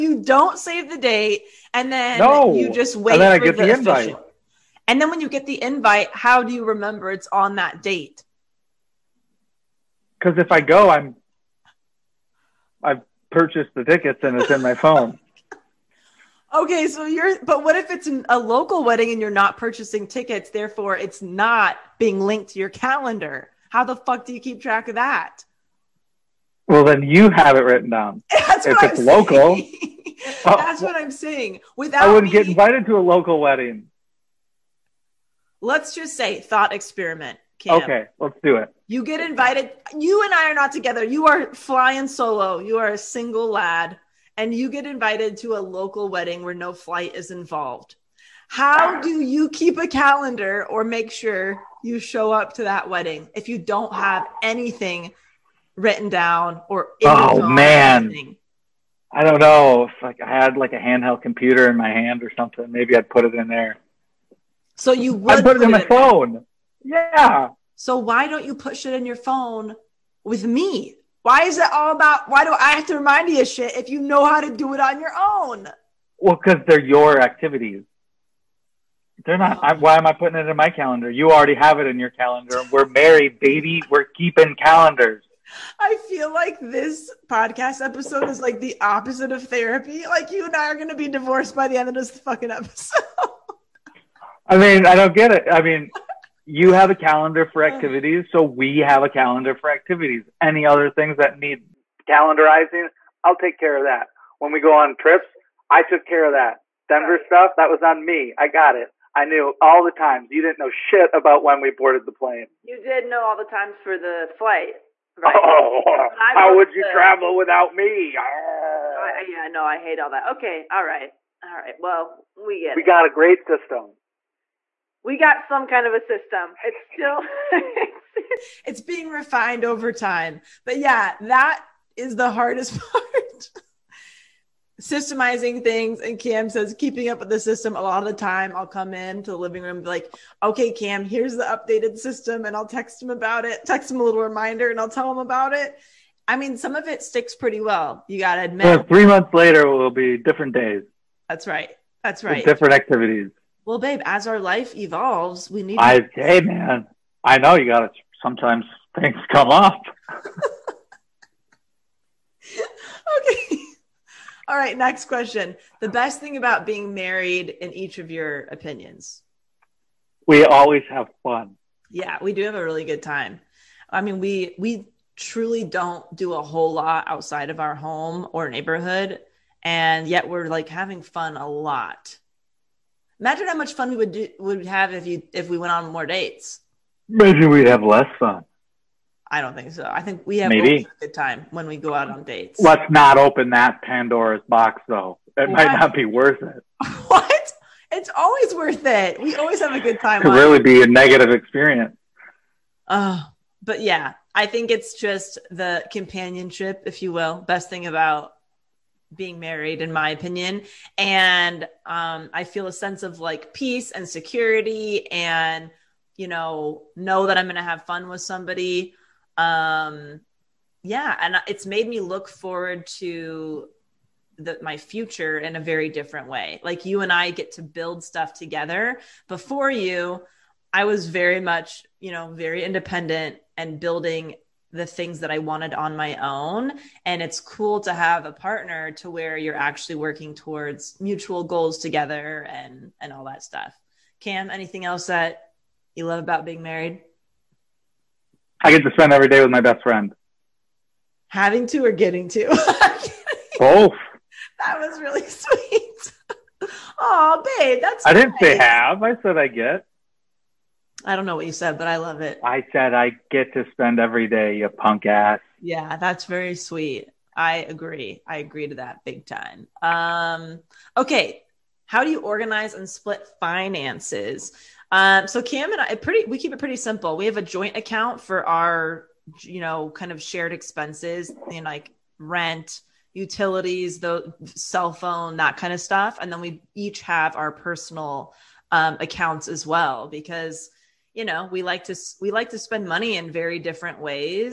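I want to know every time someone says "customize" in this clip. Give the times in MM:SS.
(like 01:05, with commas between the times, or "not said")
not said.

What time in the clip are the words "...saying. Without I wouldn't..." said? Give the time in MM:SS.
00:31.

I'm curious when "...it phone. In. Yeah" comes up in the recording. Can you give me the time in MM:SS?
01:05.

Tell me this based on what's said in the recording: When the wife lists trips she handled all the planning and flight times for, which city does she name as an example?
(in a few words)
Denver.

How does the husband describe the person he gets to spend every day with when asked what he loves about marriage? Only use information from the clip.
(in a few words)
my best friend.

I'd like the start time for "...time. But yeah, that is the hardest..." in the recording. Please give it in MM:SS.
02:09.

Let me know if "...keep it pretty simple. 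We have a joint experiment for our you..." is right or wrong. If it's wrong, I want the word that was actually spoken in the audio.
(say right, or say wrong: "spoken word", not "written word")
wrong: "account", not "experiment".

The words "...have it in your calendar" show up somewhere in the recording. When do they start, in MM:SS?
01:21.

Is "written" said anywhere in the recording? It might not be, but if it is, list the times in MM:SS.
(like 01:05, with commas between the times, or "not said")
00:27, 00:55.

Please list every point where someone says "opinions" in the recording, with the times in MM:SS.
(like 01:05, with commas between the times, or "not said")
02:48, 03:30.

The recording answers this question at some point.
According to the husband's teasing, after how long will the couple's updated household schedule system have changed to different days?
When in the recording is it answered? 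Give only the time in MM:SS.
02:28.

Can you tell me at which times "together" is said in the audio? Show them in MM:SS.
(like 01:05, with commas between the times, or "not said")
00:40, 03:48, 04:01.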